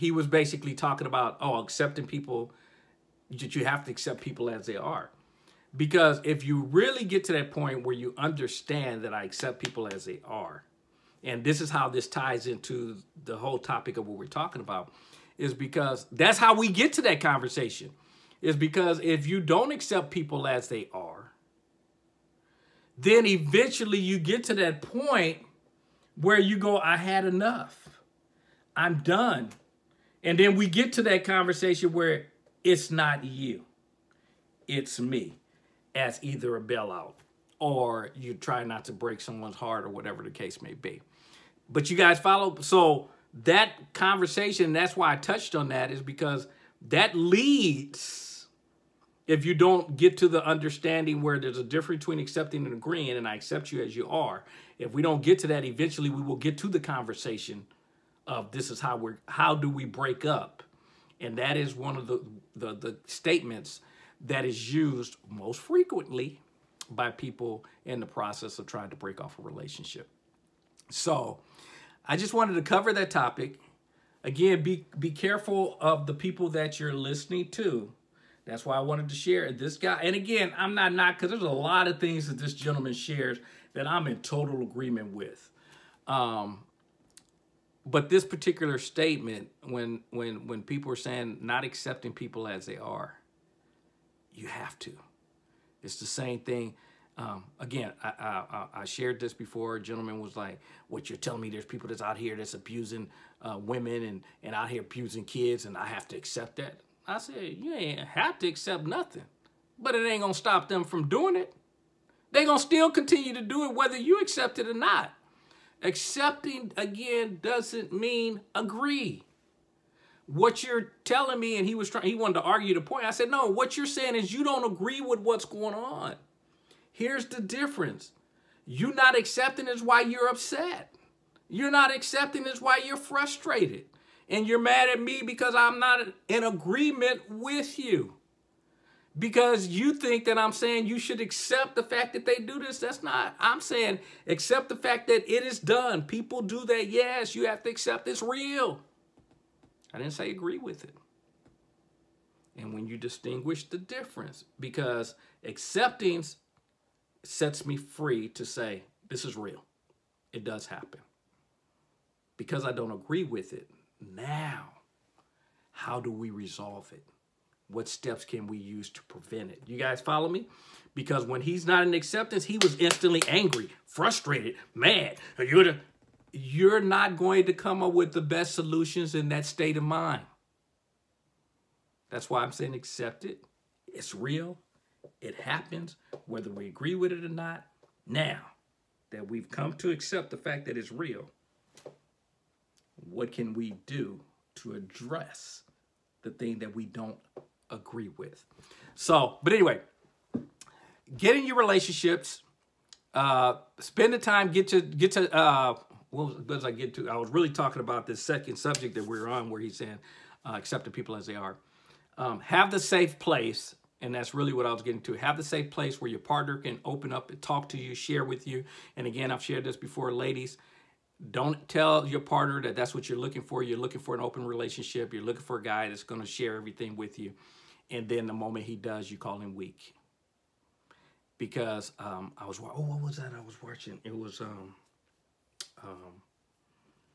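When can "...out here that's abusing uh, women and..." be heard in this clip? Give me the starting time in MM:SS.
01:42.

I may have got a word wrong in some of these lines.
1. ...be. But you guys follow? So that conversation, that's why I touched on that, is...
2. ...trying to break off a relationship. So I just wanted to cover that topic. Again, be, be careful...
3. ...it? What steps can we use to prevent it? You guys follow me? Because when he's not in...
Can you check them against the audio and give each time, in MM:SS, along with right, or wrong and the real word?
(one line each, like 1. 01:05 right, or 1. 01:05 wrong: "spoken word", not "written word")
1. 00:40 right
2. 01:08 right
3. 02:46 right.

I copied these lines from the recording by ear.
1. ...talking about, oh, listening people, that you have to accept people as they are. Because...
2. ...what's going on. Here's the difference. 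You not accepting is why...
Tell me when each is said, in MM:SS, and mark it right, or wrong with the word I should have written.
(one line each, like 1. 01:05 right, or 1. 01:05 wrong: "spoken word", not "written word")
1. 00:00 wrong: "accepting", not "listening"
2. 02:05 right.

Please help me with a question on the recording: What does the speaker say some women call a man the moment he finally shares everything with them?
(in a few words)
Weak.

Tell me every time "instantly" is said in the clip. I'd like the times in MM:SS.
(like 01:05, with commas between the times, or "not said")
02:52.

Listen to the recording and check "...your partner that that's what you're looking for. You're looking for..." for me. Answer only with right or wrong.
right.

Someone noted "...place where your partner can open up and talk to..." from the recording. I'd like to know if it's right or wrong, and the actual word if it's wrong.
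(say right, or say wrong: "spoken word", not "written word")
right.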